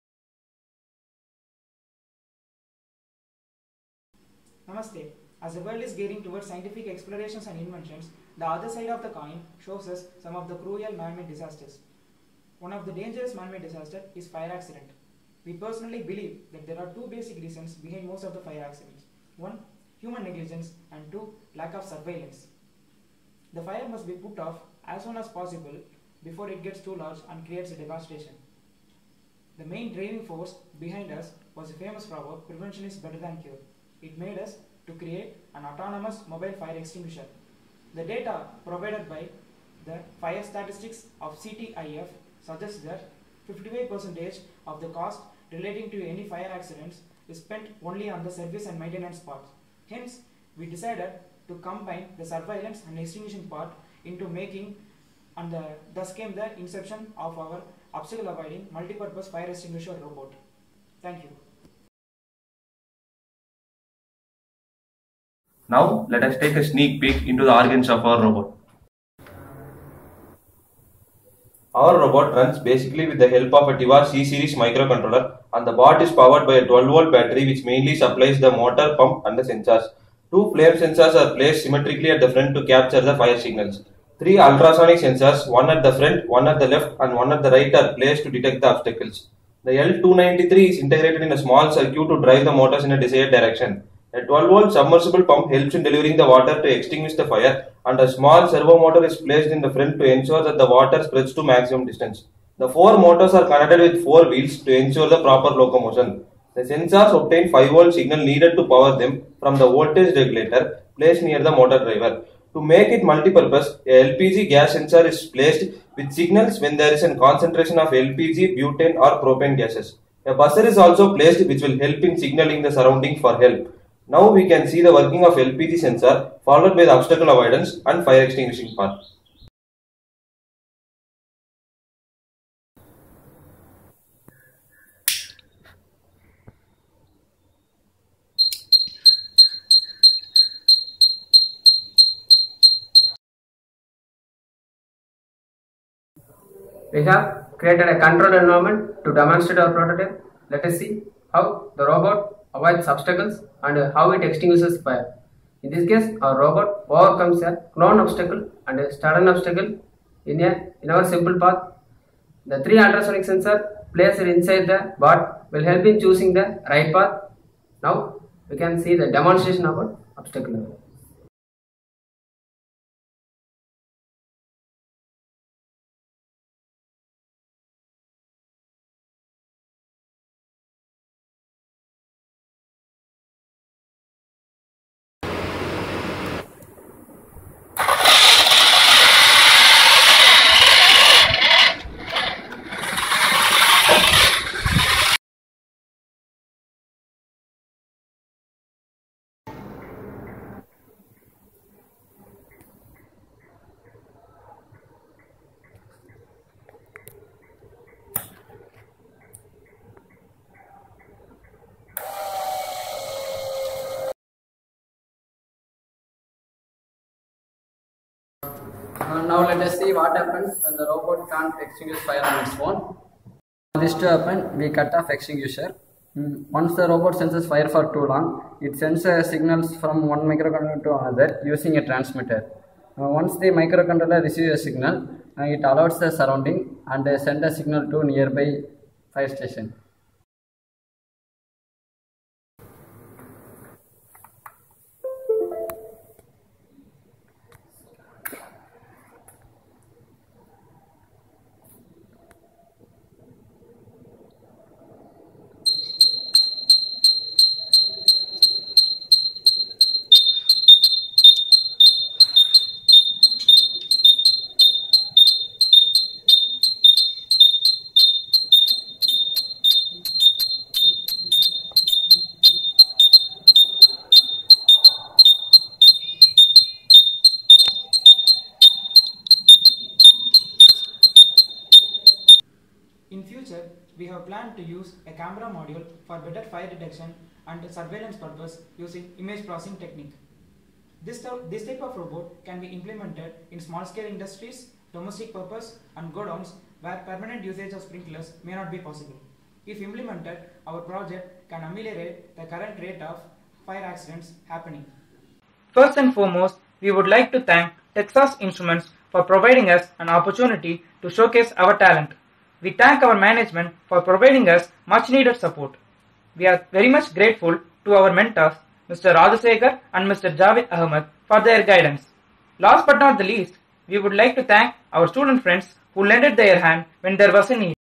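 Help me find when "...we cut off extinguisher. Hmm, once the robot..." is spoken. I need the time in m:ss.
3:44.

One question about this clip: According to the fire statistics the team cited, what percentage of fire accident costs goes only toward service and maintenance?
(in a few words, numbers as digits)
58%.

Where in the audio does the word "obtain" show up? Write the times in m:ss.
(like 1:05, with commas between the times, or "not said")
1:47.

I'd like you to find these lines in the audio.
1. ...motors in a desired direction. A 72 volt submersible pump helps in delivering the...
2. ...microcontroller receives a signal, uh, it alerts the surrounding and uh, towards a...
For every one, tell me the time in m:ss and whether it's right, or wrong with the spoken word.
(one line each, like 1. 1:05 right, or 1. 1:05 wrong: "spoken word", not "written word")
1. 1:32 wrong: "12", not "72"
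2. 3:53 wrong: "sends", not "towards".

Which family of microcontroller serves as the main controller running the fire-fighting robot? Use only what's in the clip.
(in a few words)
Tiva C-series.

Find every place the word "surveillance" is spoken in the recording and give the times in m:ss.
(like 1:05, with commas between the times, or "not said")
0:21, 0:52, 4:47.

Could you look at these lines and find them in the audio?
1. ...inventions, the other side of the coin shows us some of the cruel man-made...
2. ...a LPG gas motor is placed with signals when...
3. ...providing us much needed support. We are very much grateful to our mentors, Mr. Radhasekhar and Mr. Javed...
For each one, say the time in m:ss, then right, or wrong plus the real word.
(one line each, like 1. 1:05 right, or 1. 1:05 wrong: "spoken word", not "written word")
1. 0:07 right
2. 1:53 wrong: "sensor", not "motor"
3. 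5:14 right.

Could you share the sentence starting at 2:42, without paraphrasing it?
The three ultrasonic sensor placed inside the bot will help in choosing the right path.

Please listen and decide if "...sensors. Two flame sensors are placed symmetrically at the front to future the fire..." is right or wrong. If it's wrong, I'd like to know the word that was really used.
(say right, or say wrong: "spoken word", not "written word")
wrong: "capture", not "future".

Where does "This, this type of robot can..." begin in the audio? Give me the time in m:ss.
4:51.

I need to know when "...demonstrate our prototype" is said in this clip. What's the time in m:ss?
2:29.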